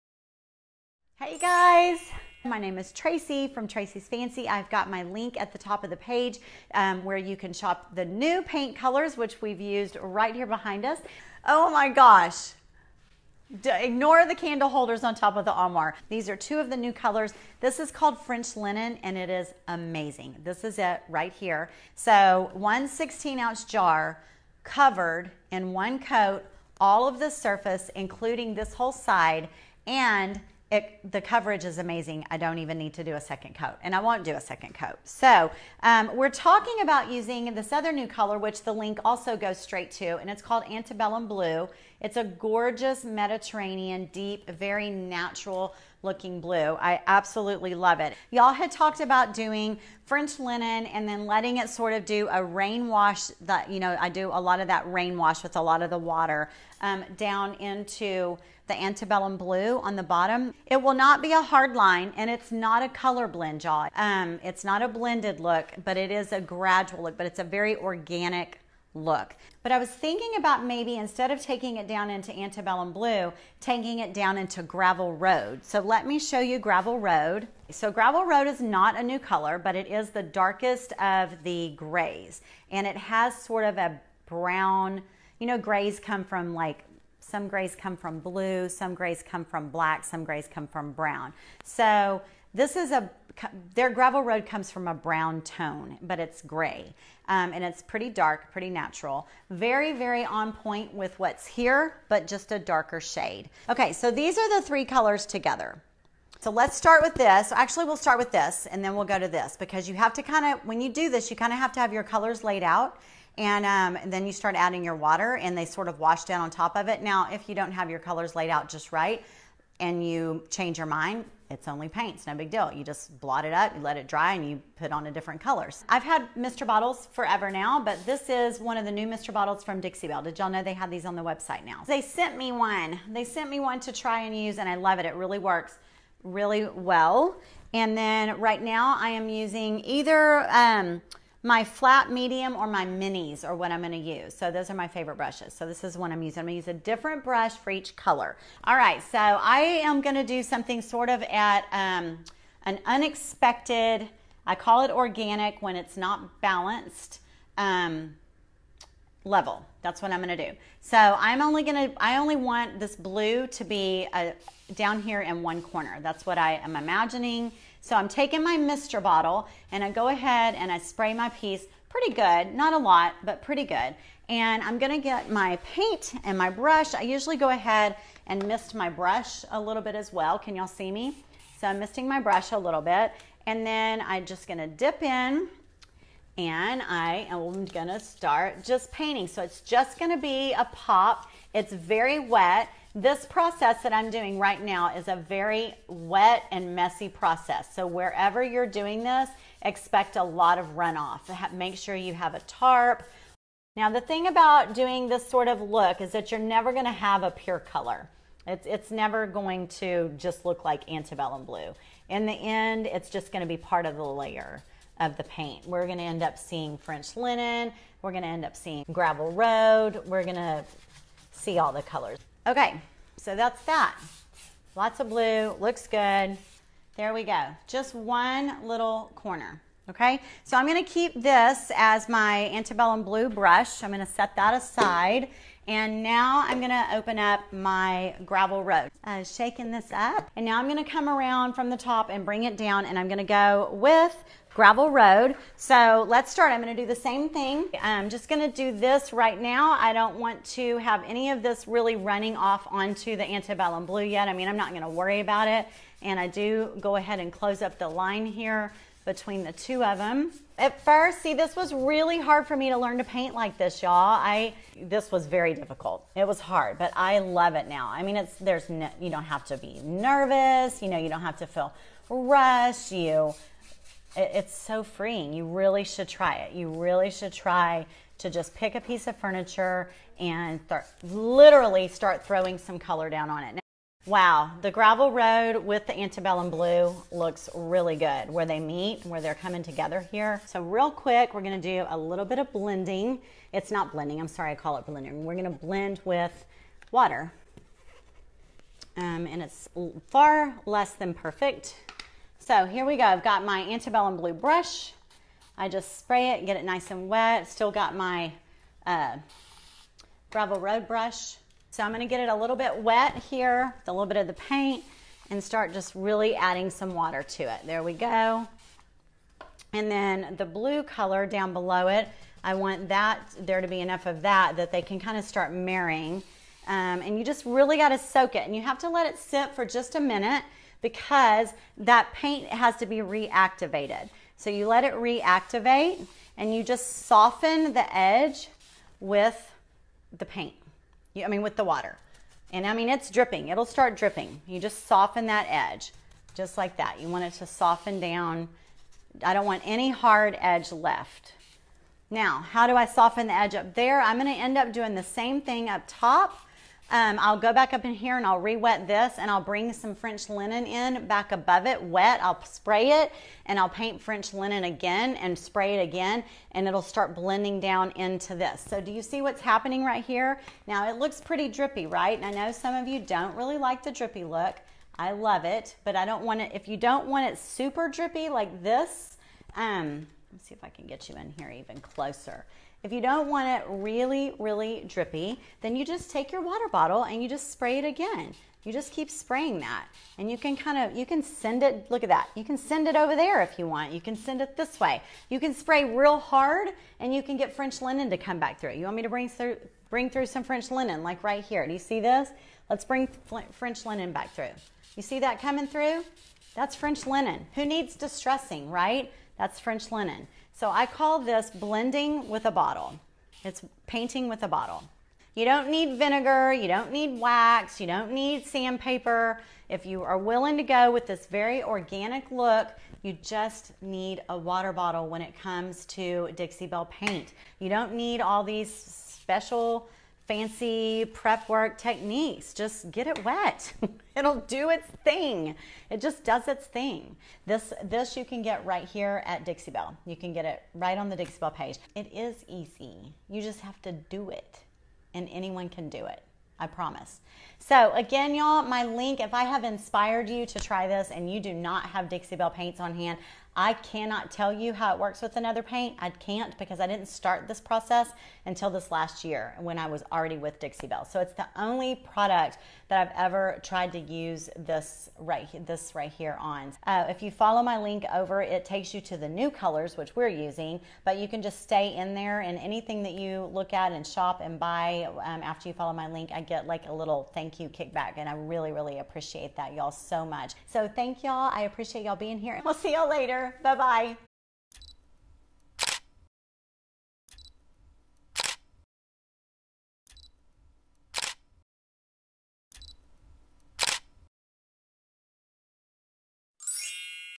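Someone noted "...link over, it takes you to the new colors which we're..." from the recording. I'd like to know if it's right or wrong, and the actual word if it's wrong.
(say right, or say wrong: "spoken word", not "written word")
right.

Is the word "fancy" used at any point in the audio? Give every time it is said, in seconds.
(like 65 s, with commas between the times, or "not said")
4 s, 430 s.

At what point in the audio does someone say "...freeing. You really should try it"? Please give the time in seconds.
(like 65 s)
274 s.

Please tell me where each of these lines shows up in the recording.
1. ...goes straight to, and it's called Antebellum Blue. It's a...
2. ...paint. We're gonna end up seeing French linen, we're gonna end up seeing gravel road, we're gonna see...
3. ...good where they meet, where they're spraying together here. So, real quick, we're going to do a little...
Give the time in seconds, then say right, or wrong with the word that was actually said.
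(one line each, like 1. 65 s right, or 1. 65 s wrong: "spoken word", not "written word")
1. 39 s right
2. 215 s right
3. 287 s wrong: "coming", not "spraying".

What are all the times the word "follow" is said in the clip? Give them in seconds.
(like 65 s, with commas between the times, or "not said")
467 s, 475 s.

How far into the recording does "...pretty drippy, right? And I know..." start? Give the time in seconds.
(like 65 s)
371 s.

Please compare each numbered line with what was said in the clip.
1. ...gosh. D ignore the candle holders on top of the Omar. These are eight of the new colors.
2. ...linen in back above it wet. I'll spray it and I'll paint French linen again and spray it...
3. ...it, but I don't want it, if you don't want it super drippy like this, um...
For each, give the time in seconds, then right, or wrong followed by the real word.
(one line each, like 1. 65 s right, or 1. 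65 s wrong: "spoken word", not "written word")
1. 11 s wrong: "two", not "eight"
2. 360 s right
3. 375 s right.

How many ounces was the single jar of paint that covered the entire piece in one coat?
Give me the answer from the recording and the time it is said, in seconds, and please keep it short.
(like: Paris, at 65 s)
16, at 22 s.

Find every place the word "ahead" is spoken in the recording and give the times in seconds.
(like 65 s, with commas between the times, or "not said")
170 s, 177 s, 256 s.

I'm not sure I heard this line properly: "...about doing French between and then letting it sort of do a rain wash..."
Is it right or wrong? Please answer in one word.
wrong.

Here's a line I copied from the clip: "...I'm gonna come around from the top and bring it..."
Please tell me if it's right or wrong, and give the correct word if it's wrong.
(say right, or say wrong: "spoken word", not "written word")
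right.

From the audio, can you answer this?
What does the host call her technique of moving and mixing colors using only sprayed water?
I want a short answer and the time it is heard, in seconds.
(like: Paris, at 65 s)
Blending with a bottle, at 411 s.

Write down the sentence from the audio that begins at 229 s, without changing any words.
Okay, so I'm gonna keep this as my antebellum blue brush.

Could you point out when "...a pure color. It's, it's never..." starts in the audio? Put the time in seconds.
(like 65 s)
207 s.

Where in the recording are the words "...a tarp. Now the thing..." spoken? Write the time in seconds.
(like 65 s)
202 s.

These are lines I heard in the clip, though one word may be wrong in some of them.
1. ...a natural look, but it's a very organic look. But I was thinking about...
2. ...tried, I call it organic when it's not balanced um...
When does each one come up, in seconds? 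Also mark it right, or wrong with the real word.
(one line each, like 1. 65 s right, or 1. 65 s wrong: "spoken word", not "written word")
1. 66 s wrong: "gradual", not "natural"
2. 152 s wrong: "unexpected", not "tried".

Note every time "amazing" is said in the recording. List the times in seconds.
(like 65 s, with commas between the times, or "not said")
19 s, 31 s.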